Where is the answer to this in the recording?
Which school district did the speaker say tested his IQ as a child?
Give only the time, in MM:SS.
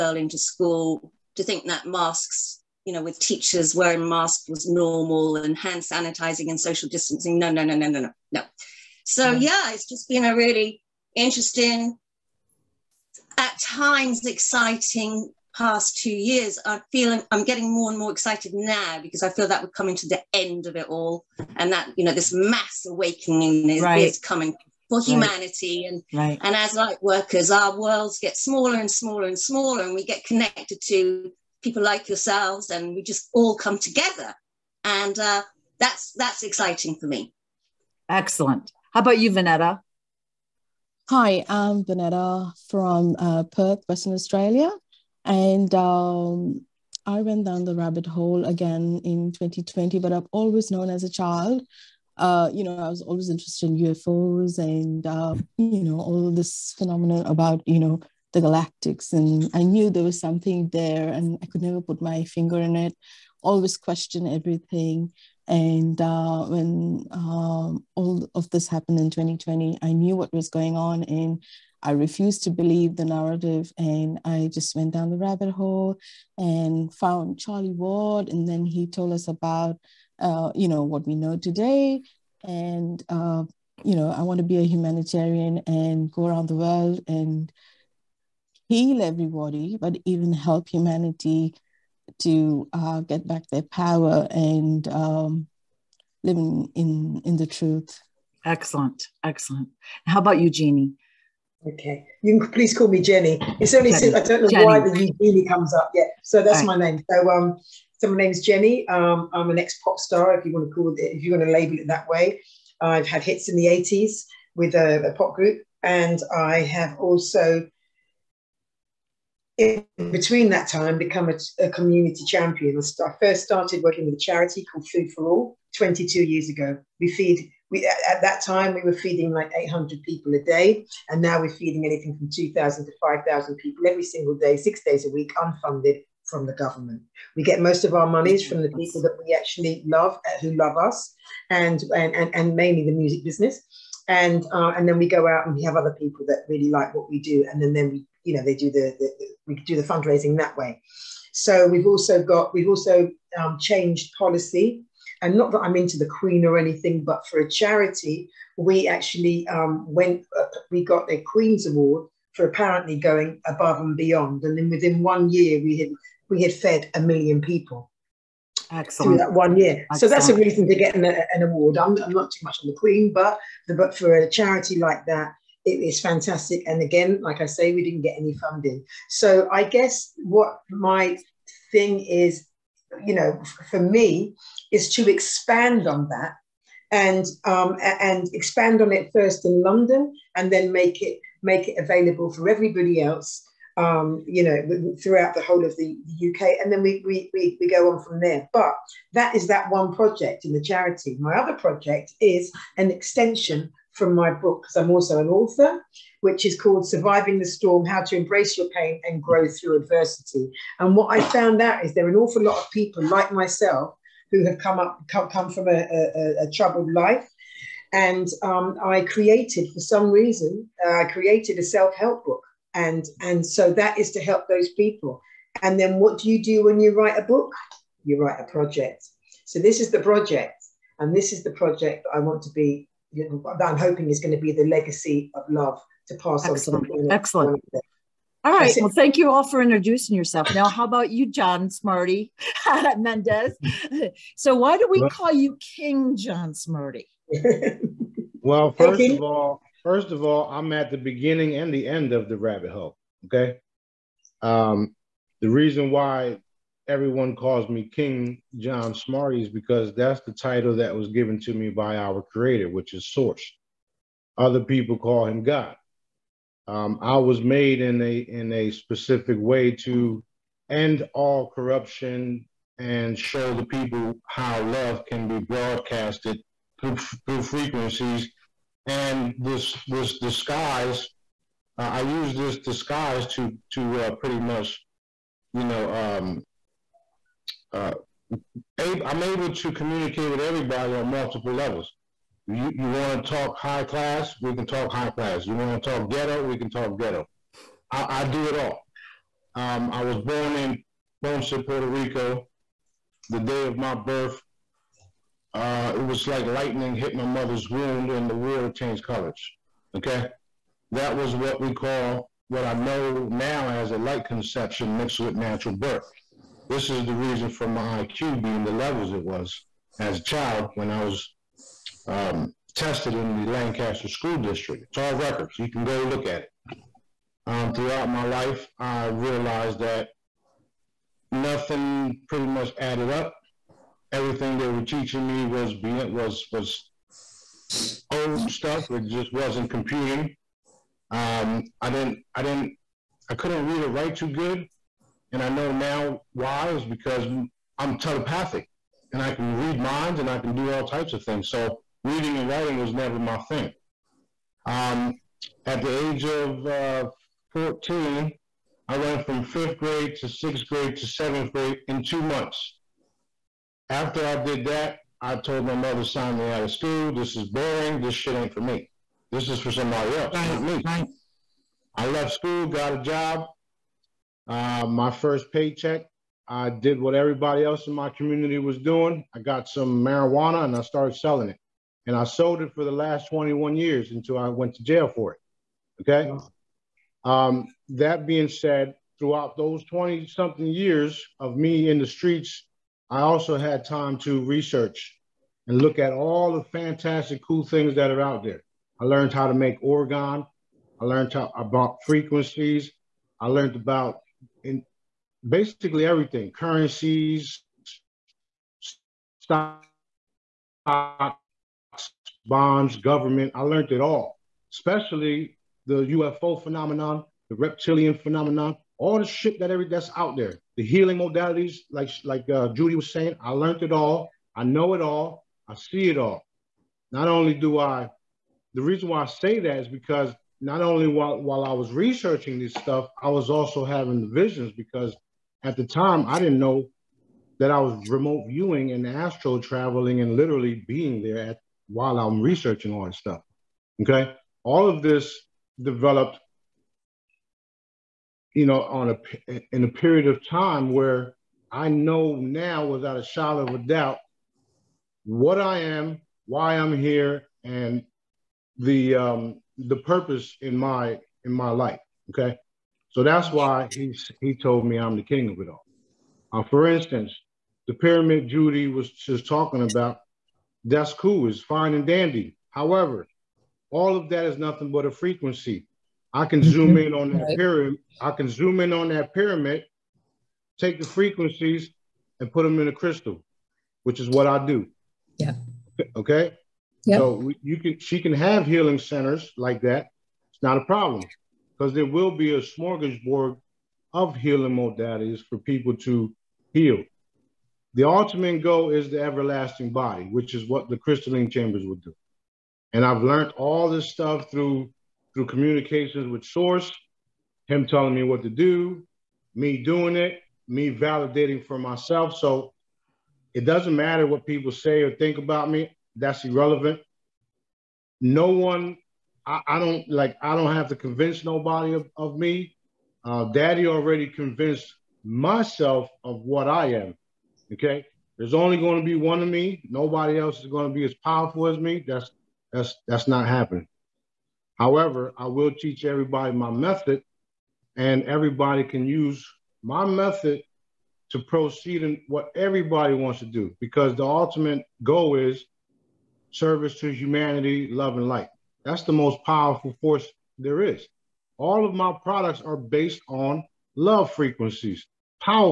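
05:23.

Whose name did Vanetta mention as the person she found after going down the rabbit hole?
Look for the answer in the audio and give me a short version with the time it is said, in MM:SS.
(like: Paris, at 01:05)
Charlie Ward, at 01:17.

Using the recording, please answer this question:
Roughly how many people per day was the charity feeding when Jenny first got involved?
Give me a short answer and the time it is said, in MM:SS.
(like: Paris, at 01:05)
800, at 02:09.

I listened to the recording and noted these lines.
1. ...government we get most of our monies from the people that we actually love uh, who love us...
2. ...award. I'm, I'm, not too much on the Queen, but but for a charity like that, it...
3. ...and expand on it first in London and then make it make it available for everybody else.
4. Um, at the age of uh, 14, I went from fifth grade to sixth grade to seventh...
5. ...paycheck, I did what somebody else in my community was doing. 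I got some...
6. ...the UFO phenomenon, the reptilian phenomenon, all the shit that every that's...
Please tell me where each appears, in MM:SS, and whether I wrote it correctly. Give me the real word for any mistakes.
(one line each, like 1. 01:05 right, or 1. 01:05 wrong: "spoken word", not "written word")
1. 02:16 right
2. 02:51 right
3. 03:07 right
4. 05:54 right
5. 06:15 wrong: "everybody", not "somebody"
6. 06:55 right.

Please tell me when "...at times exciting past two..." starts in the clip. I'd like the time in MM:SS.
00:13.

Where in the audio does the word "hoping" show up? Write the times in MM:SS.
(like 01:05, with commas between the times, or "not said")
03:53.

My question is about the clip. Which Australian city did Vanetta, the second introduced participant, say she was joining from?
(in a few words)
Perth.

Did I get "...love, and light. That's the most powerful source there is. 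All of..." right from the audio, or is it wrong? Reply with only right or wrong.
wrong.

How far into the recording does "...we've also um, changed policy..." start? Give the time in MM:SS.
02:32.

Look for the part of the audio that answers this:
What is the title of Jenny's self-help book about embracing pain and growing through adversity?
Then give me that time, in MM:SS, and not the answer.
03:26.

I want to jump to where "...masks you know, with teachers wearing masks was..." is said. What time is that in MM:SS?
00:01.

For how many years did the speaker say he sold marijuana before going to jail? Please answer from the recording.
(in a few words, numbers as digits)
21.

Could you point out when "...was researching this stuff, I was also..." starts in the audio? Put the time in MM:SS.
07:11.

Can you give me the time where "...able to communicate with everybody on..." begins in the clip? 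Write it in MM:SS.
04:49.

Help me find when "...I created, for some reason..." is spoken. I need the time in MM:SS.
03:38.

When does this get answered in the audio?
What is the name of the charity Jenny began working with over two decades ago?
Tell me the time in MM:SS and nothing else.
02:04.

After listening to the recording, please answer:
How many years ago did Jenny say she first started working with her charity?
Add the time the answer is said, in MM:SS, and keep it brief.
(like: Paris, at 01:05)
22, at 02:05.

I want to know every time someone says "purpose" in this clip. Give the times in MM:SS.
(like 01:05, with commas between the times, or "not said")
07:39.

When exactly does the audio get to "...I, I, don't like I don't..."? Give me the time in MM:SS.
08:39.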